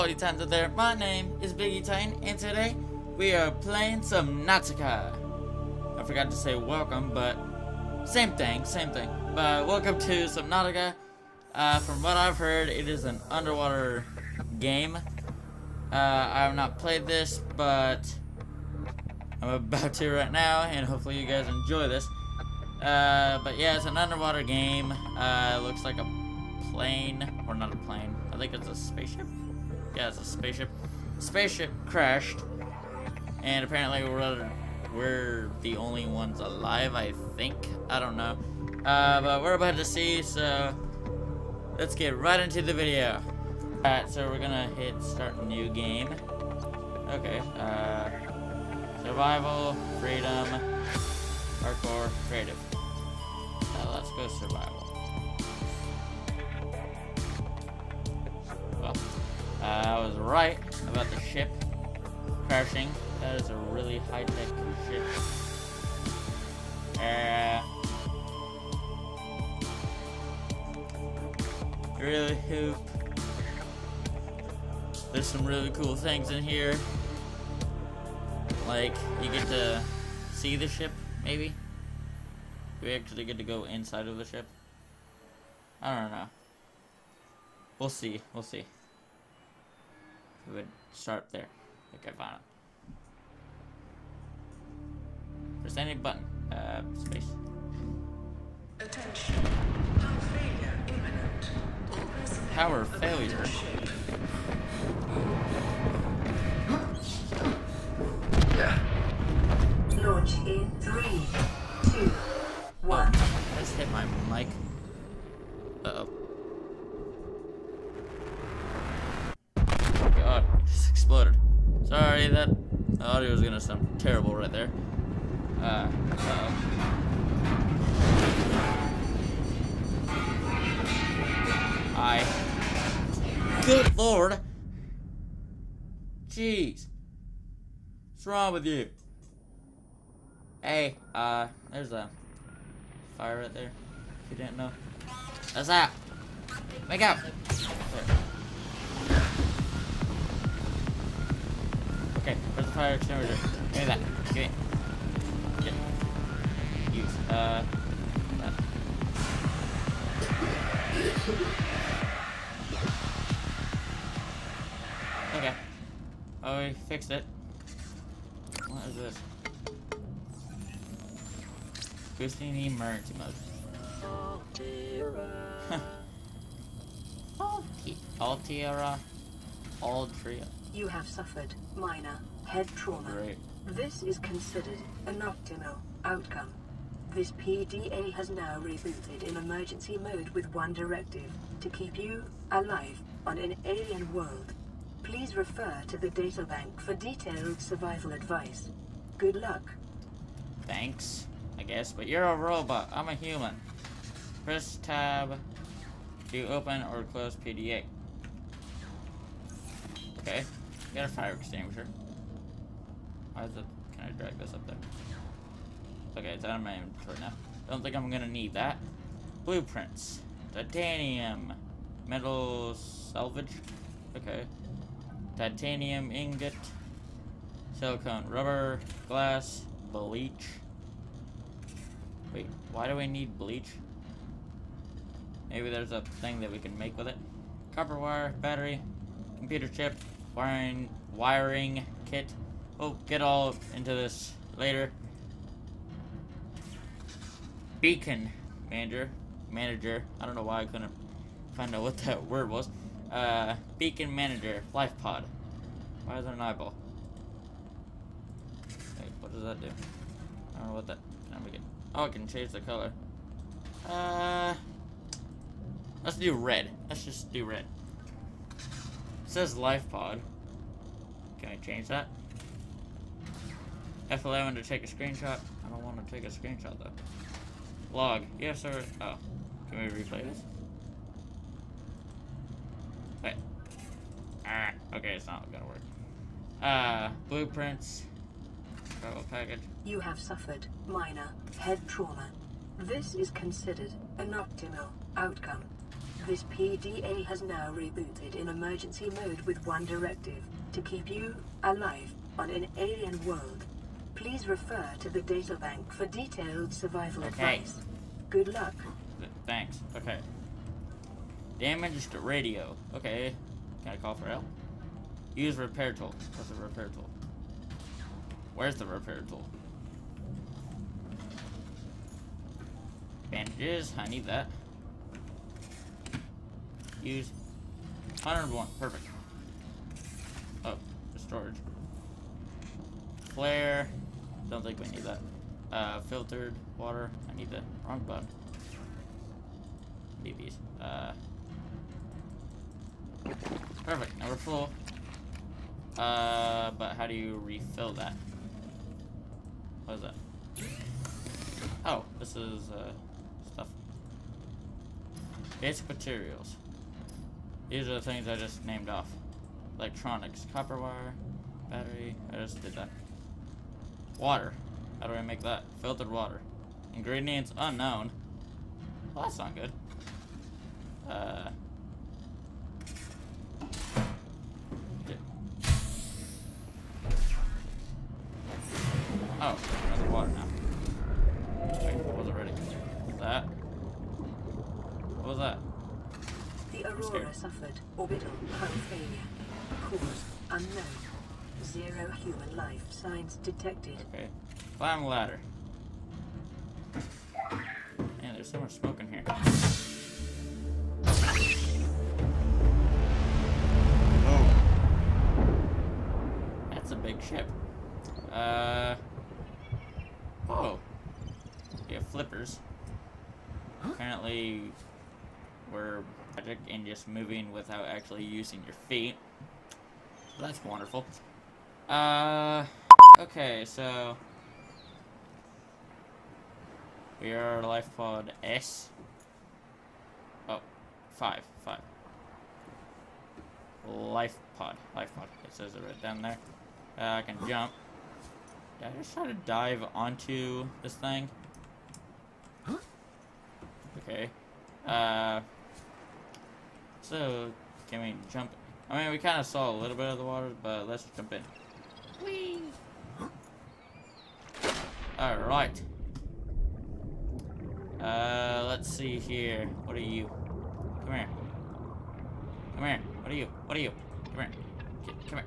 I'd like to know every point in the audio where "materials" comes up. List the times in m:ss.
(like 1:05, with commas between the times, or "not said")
5:55.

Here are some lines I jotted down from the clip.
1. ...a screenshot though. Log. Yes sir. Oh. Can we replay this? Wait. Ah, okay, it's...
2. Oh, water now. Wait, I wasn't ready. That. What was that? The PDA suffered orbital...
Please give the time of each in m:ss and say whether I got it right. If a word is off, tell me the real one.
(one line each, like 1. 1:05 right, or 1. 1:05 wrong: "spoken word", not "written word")
1. 4:36 right
2. 6:19 wrong: "Aurora", not "PDA".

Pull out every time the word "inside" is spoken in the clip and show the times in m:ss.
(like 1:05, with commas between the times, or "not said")
1:23.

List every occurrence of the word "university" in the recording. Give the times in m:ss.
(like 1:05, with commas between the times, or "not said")
not said.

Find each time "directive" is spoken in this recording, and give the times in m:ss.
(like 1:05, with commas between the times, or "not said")
3:10, 4:59.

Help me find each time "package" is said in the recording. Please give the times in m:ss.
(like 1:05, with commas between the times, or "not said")
4:49.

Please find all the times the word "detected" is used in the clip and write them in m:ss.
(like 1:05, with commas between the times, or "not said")
6:33.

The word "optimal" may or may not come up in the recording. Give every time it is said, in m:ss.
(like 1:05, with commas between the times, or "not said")
3:05, 4:54.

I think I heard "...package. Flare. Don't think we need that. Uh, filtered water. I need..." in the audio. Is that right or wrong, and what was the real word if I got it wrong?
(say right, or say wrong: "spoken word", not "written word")
wrong: "storage", not "package".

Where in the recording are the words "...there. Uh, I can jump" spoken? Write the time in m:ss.
7:16.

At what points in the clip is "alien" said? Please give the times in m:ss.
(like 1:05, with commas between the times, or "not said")
3:13, 5:02.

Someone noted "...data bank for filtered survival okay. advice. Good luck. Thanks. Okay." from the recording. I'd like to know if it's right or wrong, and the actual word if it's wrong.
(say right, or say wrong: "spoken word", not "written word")
wrong: "detailed", not "filtered".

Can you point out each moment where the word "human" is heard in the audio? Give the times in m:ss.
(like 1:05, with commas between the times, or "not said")
3:23, 6:32.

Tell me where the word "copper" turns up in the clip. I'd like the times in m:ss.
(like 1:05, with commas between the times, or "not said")
3:57, 6:00.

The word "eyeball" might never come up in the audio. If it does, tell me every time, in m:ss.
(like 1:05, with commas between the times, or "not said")
4:16.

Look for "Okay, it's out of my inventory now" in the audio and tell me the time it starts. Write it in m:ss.
3:36.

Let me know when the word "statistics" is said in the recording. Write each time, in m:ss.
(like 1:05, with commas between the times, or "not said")
not said.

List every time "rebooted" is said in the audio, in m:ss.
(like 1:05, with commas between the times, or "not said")
3:08, 4:57.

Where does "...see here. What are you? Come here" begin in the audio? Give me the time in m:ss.
7:38.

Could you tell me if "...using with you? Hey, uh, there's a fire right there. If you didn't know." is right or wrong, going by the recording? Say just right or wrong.
wrong.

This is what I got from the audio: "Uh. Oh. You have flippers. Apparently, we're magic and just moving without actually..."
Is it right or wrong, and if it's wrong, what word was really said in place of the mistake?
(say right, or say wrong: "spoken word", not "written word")
right.